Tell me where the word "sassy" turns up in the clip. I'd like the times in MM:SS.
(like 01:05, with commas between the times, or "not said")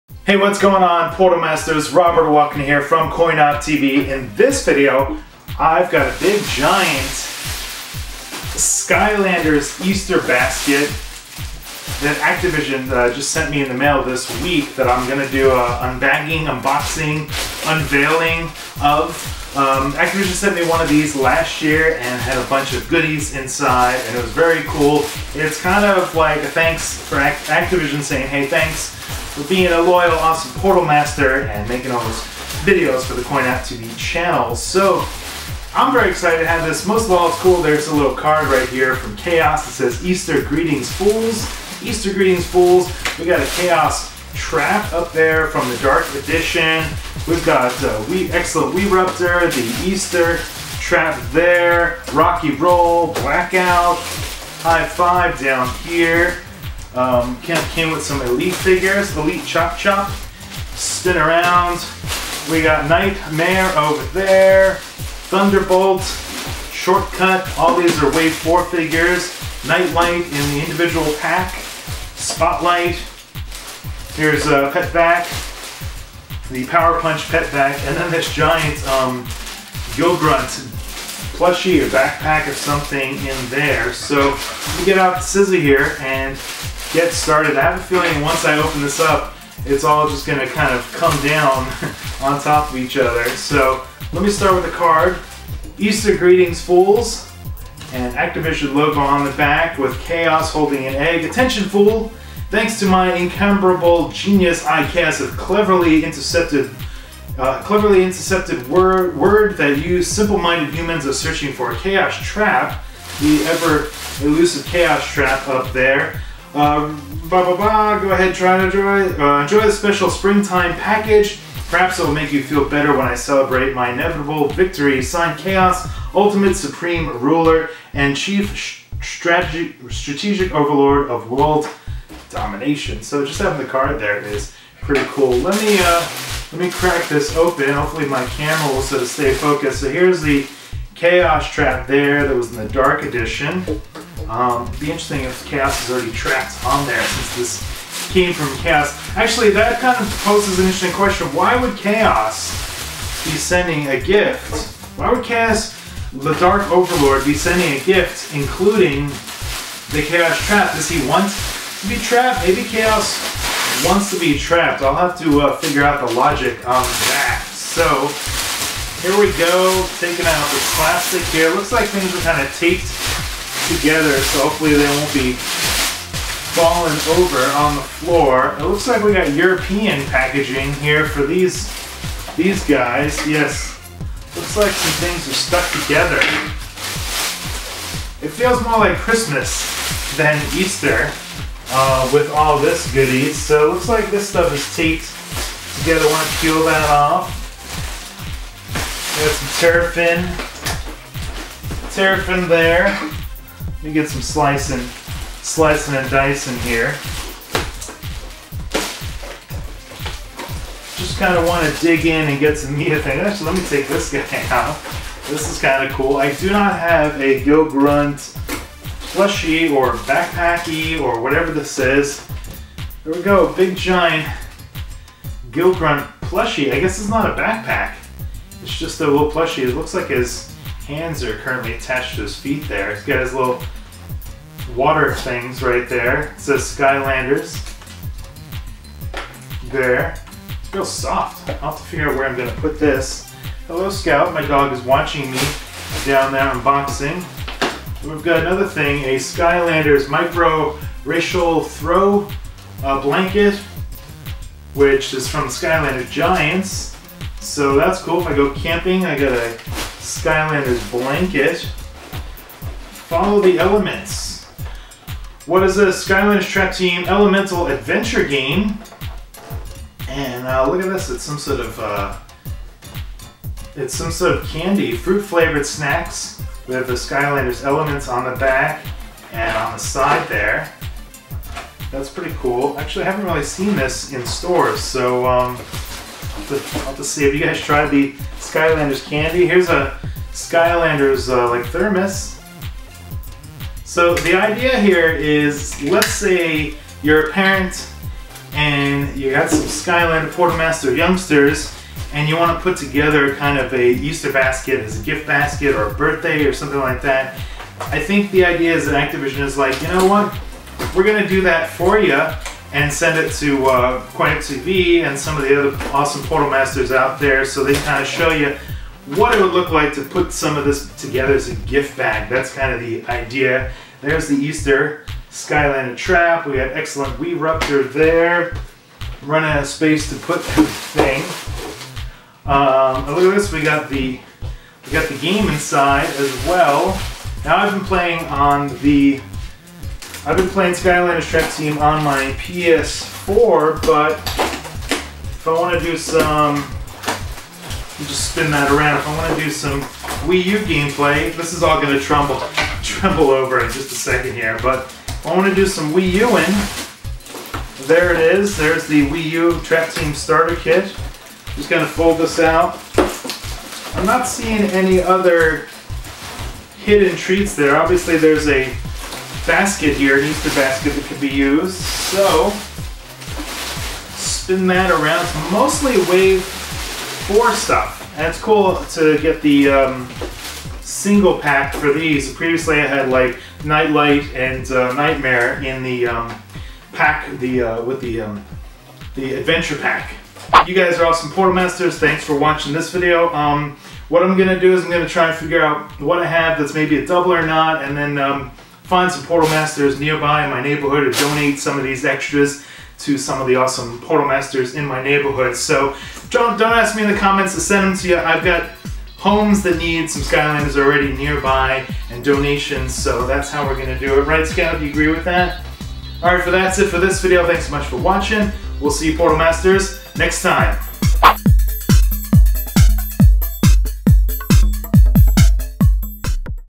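not said.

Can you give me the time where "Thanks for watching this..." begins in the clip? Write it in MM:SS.
06:31.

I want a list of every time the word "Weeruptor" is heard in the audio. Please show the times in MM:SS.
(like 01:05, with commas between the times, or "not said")
00:48, 05:27.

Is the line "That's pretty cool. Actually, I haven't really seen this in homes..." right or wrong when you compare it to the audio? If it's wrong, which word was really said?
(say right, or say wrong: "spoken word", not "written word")
wrong: "stores", not "homes".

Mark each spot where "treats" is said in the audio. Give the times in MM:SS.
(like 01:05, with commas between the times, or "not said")
06:07.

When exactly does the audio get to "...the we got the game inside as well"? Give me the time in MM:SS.
05:33.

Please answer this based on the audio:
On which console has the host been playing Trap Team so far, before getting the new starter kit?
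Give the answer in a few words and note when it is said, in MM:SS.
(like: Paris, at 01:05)
PS4, at 05:42.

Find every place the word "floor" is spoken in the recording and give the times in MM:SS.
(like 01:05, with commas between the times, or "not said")
02:57.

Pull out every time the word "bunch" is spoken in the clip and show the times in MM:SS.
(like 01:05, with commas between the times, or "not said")
00:22.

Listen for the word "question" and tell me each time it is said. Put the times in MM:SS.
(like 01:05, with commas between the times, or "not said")
02:30.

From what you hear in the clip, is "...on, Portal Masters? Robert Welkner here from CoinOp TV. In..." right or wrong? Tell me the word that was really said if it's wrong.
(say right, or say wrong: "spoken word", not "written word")
right.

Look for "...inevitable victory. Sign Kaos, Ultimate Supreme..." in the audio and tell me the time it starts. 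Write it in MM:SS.
02:03.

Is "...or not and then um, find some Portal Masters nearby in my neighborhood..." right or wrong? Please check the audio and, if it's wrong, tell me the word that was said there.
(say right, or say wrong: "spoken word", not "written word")
right.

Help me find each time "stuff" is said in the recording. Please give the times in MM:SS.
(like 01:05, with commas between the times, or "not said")
03:14, 06:17.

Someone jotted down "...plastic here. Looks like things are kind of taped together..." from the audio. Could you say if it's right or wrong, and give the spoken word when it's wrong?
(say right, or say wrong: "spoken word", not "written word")
right.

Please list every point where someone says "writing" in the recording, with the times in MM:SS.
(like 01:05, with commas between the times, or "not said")
not said.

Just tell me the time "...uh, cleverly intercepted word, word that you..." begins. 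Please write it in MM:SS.
01:47.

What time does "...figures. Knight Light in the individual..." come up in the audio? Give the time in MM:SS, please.
01:08.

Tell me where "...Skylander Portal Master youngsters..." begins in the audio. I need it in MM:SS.
04:59.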